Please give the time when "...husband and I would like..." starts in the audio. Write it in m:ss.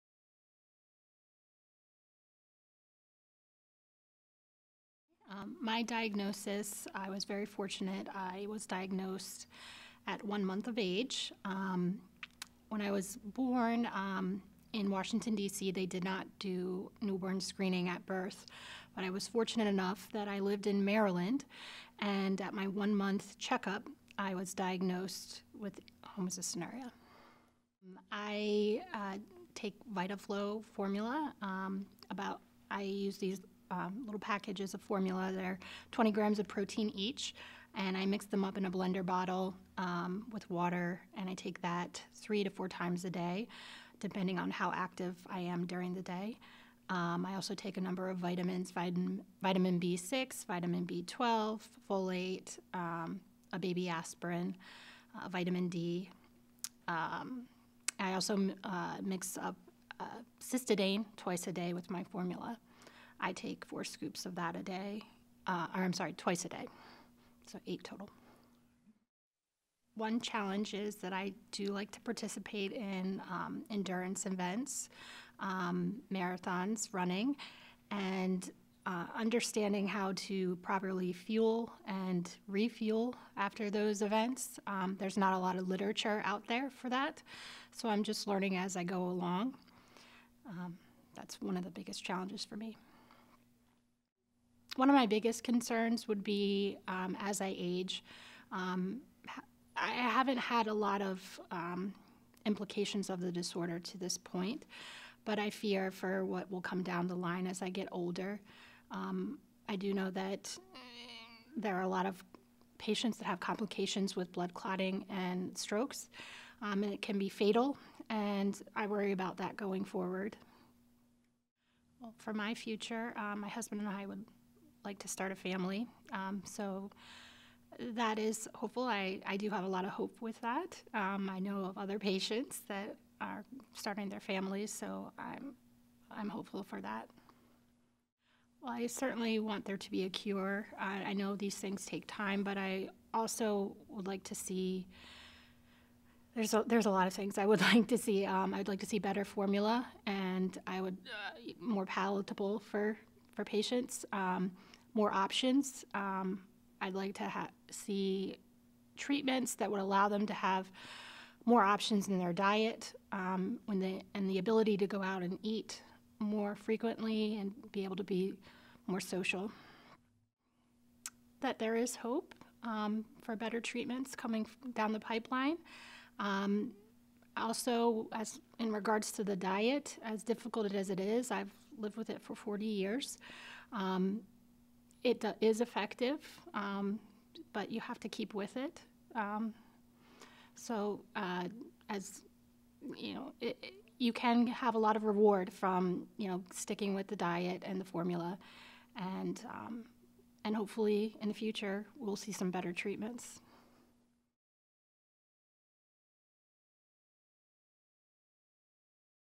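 2:03.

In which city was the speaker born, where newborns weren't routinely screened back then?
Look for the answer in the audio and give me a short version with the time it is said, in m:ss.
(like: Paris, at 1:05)
Washington, D.C., at 0:14.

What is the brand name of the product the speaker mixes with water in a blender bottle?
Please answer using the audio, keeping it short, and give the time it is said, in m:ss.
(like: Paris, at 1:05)
Vitaflo, at 0:29.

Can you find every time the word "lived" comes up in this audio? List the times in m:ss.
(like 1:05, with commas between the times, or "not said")
0:20, 3:01.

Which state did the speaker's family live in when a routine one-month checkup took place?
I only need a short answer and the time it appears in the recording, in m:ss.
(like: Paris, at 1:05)
Maryland, at 0:20.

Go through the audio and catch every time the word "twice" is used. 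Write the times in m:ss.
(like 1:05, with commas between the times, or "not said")
1:01, 1:06.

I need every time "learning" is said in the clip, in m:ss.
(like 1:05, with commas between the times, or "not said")
1:28.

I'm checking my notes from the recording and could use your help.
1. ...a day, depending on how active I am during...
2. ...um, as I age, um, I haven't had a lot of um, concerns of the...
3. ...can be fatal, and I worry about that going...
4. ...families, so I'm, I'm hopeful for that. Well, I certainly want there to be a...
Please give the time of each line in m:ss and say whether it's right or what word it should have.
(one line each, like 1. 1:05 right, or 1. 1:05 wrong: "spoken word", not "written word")
1. 0:43 right
2. 1:36 wrong: "implications", not "concerns"
3. 1:57 right
4. 2:14 right.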